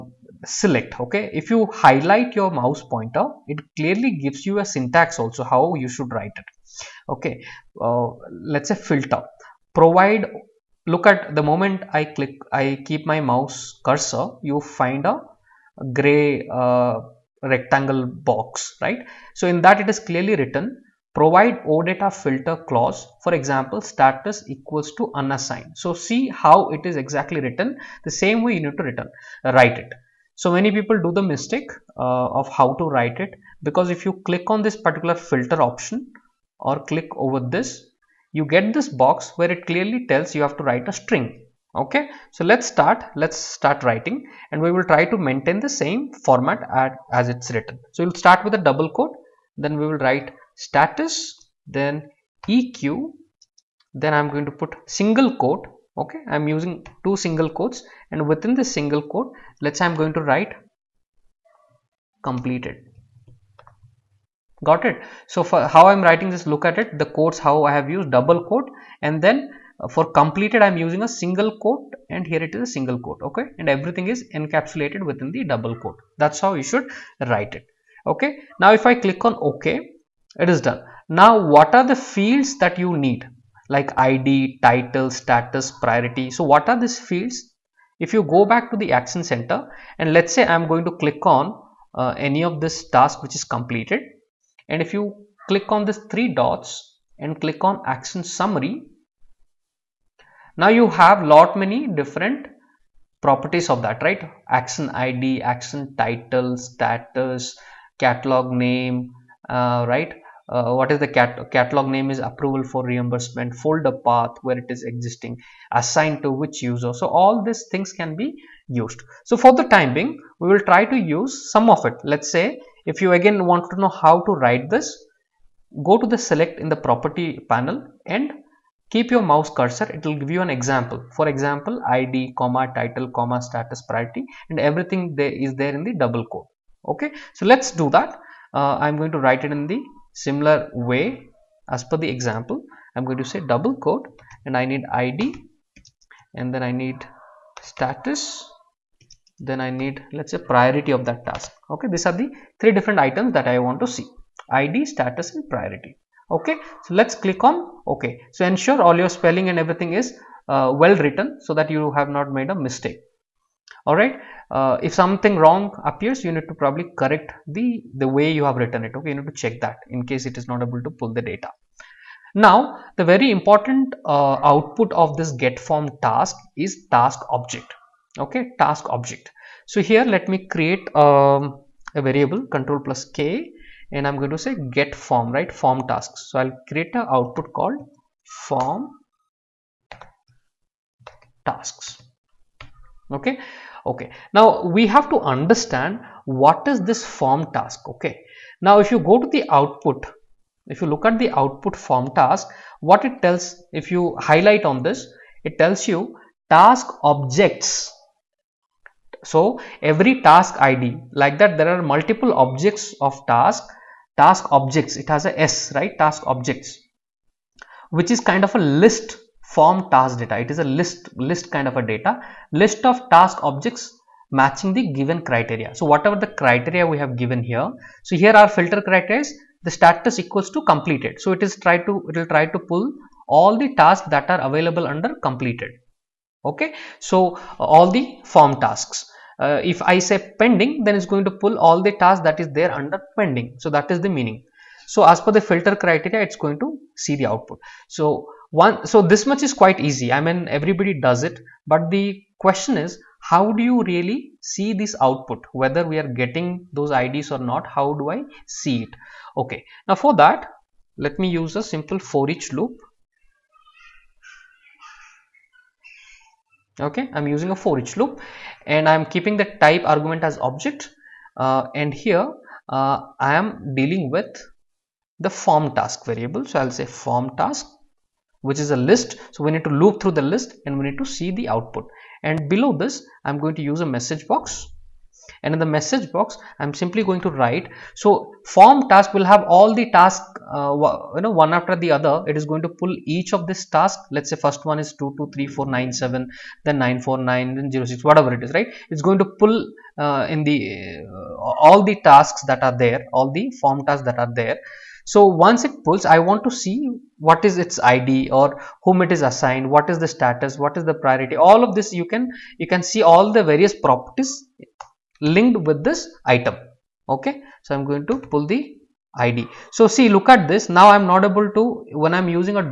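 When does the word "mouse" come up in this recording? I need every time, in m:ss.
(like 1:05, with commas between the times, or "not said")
0:02, 0:13, 2:09.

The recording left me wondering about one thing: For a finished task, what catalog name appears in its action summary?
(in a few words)
approval for reimbursement.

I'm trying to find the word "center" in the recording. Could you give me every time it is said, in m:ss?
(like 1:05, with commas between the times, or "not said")
1:29.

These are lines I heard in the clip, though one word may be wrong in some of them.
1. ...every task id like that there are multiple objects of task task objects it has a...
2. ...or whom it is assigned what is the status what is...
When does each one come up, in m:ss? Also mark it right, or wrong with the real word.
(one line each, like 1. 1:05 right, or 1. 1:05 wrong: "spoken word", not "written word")
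1. 3:29 right
2. 5:08 right.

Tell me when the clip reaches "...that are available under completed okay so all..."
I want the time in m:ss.
3:54.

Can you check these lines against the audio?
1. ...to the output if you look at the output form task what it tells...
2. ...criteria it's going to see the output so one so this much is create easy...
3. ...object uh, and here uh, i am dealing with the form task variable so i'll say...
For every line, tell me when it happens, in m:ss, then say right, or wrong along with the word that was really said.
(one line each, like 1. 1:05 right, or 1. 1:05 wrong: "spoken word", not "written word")
1. 3:19 right
2. 4:05 wrong: "quite", not "create"
3. 4:30 right.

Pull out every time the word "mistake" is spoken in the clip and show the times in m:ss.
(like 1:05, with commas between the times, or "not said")
0:31, 2:42.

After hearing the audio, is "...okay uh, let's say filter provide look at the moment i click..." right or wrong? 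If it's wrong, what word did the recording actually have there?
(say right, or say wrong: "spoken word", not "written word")
right.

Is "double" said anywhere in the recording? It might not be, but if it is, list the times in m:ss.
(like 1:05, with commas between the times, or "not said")
0:48, 1:08, 1:15, 2:15, 2:23.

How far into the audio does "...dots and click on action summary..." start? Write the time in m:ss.
1:36.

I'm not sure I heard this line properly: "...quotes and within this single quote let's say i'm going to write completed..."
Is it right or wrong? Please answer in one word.
right.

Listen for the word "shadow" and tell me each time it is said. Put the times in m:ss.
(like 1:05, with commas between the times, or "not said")
not said.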